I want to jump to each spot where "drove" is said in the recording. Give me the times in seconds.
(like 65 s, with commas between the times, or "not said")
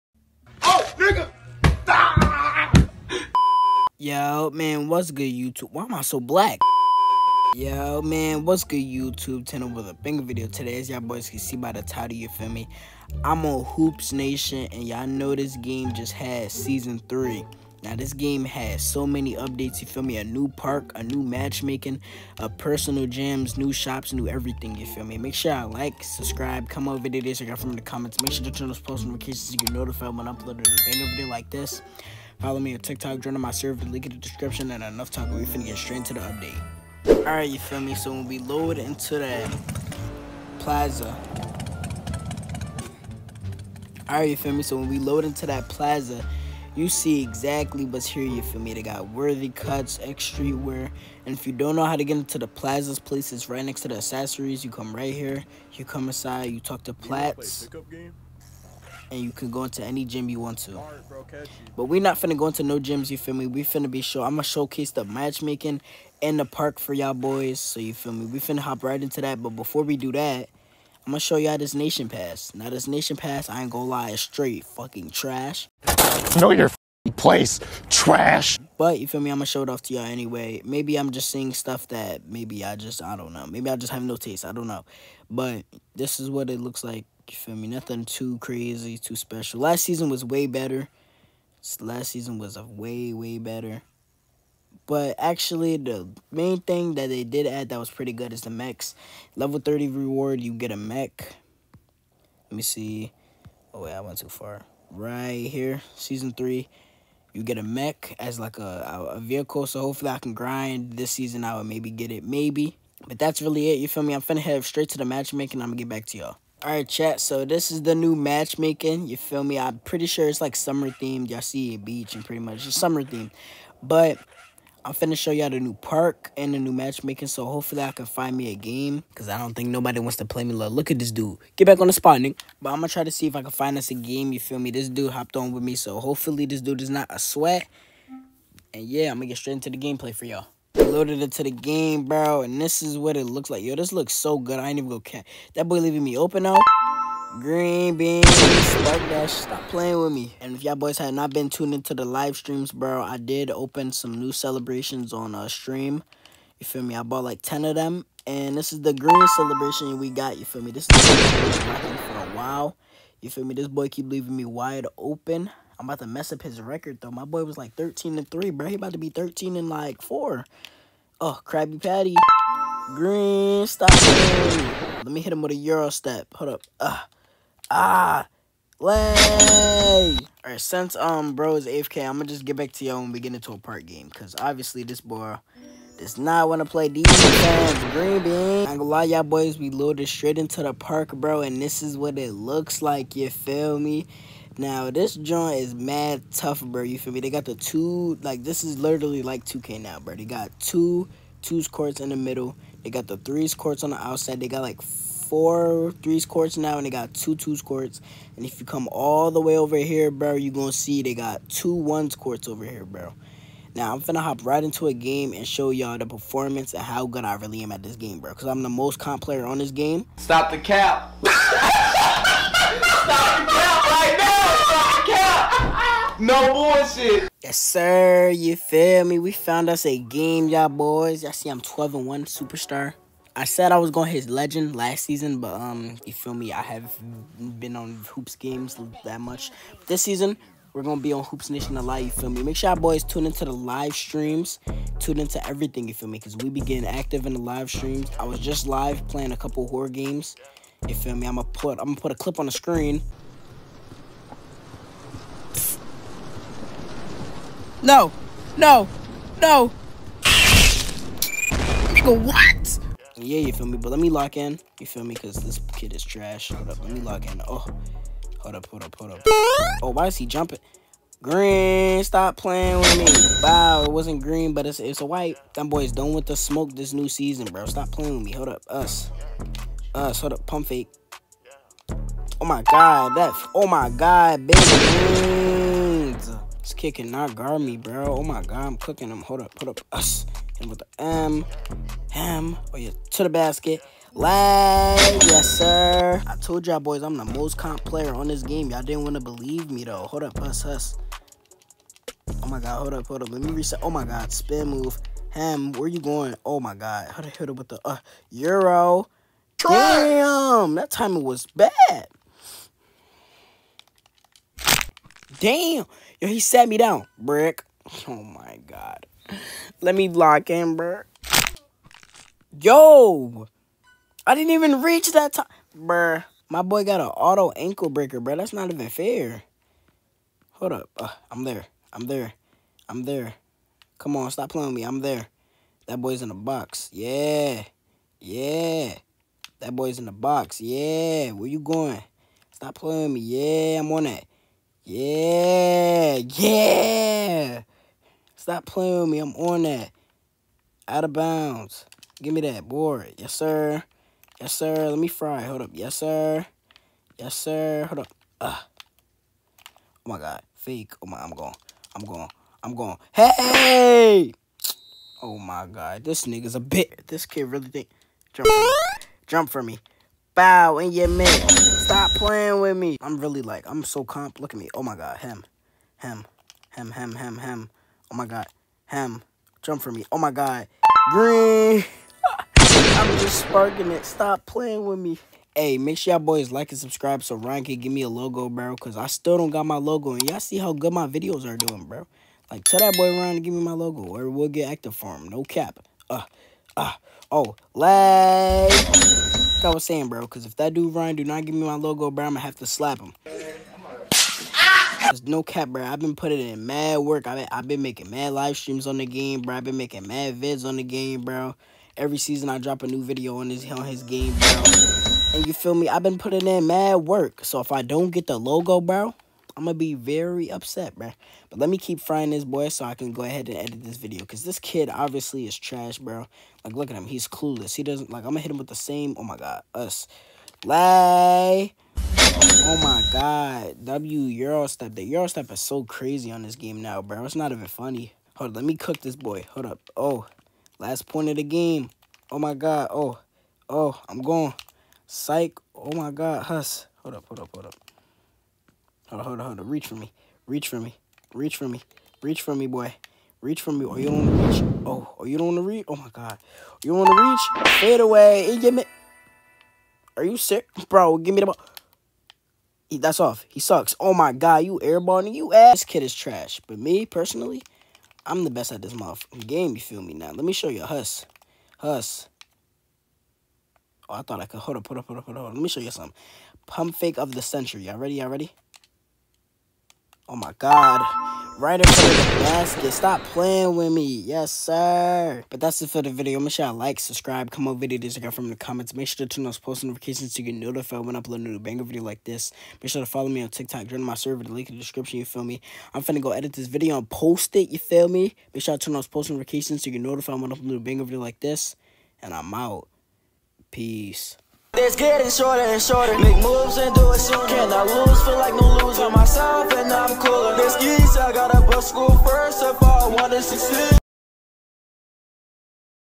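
not said.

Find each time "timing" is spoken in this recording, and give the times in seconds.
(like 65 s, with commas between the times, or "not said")
310 s.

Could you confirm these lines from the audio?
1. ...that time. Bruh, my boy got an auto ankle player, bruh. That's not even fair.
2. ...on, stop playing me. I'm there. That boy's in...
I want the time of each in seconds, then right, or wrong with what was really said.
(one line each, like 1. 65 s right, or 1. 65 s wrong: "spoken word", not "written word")
1. 325 s wrong: "breaker", not "player"
2. 334 s right.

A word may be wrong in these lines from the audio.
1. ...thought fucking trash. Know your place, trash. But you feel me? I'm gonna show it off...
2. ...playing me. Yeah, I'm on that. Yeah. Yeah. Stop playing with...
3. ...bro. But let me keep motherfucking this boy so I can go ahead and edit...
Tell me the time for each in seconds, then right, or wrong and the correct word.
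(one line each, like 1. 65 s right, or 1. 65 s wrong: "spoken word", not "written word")
1. 74 s wrong: "straight", not "thought"
2. 342 s right
3. 420 s wrong: "frying", not "motherfucking".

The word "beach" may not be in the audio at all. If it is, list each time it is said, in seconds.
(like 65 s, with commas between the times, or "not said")
121 s.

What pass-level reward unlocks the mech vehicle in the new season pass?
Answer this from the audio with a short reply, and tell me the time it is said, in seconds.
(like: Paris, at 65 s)
Level 30, at 99 s.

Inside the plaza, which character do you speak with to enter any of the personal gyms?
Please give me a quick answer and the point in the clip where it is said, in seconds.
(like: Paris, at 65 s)
Plats, at 56 s.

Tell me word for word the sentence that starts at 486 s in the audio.
Make sure I like, subscribe, comment, over videos from the comments.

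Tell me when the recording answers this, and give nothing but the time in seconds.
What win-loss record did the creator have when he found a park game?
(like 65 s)
231 s.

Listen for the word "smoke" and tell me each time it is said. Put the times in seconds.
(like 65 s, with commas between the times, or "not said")
276 s.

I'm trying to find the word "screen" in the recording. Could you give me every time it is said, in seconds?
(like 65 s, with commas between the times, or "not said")
252 s.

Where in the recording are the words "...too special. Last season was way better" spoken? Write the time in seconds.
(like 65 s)
88 s.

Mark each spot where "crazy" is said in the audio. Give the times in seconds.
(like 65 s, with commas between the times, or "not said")
88 s, 435 s.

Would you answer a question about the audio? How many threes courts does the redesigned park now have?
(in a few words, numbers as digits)
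4.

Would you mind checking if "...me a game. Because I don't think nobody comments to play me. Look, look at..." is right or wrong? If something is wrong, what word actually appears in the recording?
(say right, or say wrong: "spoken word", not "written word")
wrong: "wants", not "comments".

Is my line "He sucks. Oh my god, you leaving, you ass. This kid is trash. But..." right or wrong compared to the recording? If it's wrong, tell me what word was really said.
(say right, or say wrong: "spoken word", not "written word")
wrong: "airballing", not "leaving".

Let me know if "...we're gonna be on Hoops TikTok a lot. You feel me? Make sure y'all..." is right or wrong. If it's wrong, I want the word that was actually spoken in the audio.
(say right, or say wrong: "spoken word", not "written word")
wrong: "Nation", not "TikTok".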